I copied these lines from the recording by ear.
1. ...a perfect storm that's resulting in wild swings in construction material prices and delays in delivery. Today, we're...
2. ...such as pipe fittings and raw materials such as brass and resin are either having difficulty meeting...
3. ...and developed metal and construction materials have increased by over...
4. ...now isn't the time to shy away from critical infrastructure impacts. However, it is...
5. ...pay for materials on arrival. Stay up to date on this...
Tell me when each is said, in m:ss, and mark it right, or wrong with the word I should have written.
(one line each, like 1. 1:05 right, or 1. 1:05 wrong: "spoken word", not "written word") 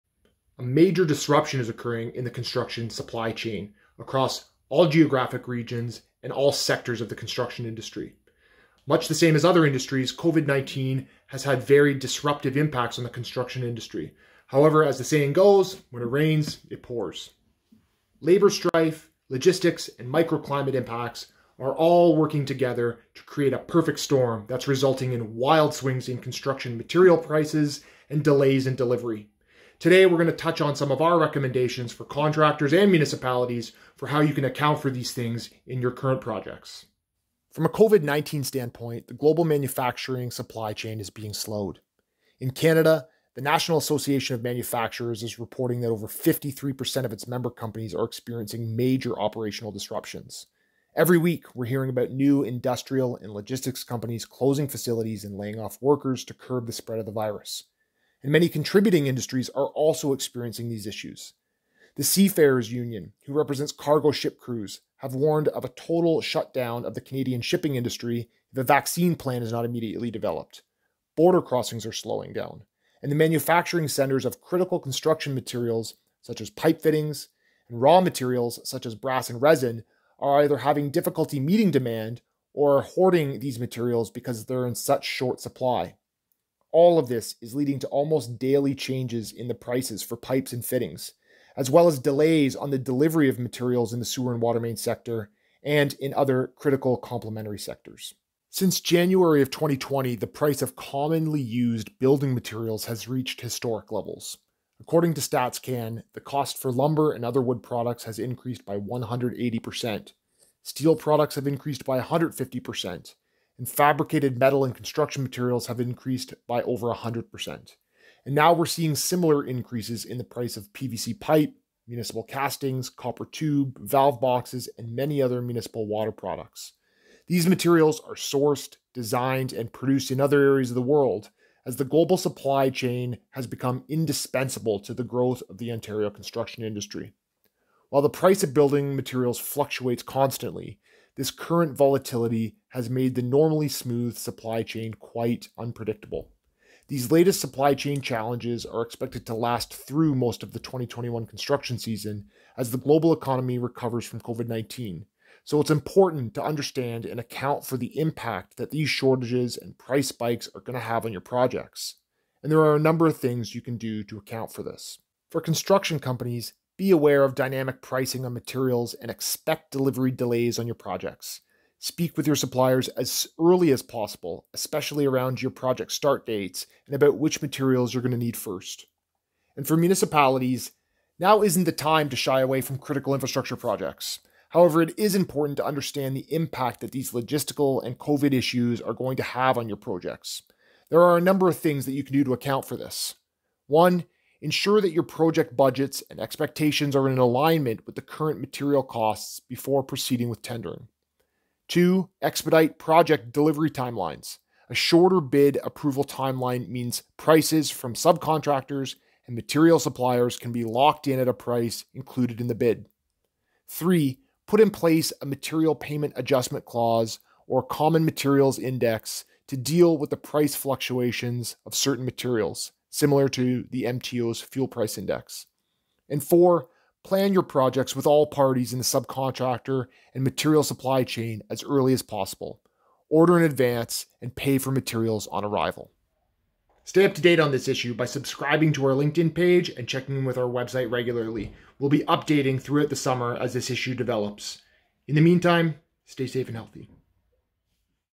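1. 0:23 right
2. 1:16 right
3. 1:53 wrong: "fabricated", not "developed"
4. 3:01 wrong: "projects", not "impacts"
5. 3:54 right.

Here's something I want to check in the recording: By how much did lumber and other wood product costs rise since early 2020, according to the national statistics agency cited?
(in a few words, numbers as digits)
180%.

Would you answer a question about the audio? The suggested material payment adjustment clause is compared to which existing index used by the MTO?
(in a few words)
fuel price index.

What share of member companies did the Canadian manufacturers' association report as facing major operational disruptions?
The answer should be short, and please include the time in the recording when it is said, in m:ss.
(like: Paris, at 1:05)
over 53%, at 0:45.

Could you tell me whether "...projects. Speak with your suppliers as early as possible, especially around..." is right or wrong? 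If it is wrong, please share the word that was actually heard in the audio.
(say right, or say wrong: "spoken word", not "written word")
right.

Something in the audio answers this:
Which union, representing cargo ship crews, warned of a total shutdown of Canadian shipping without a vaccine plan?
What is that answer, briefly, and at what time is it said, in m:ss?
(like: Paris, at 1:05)
Seafarers Union, at 1:02.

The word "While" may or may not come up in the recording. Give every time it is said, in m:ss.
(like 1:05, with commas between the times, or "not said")
2:17.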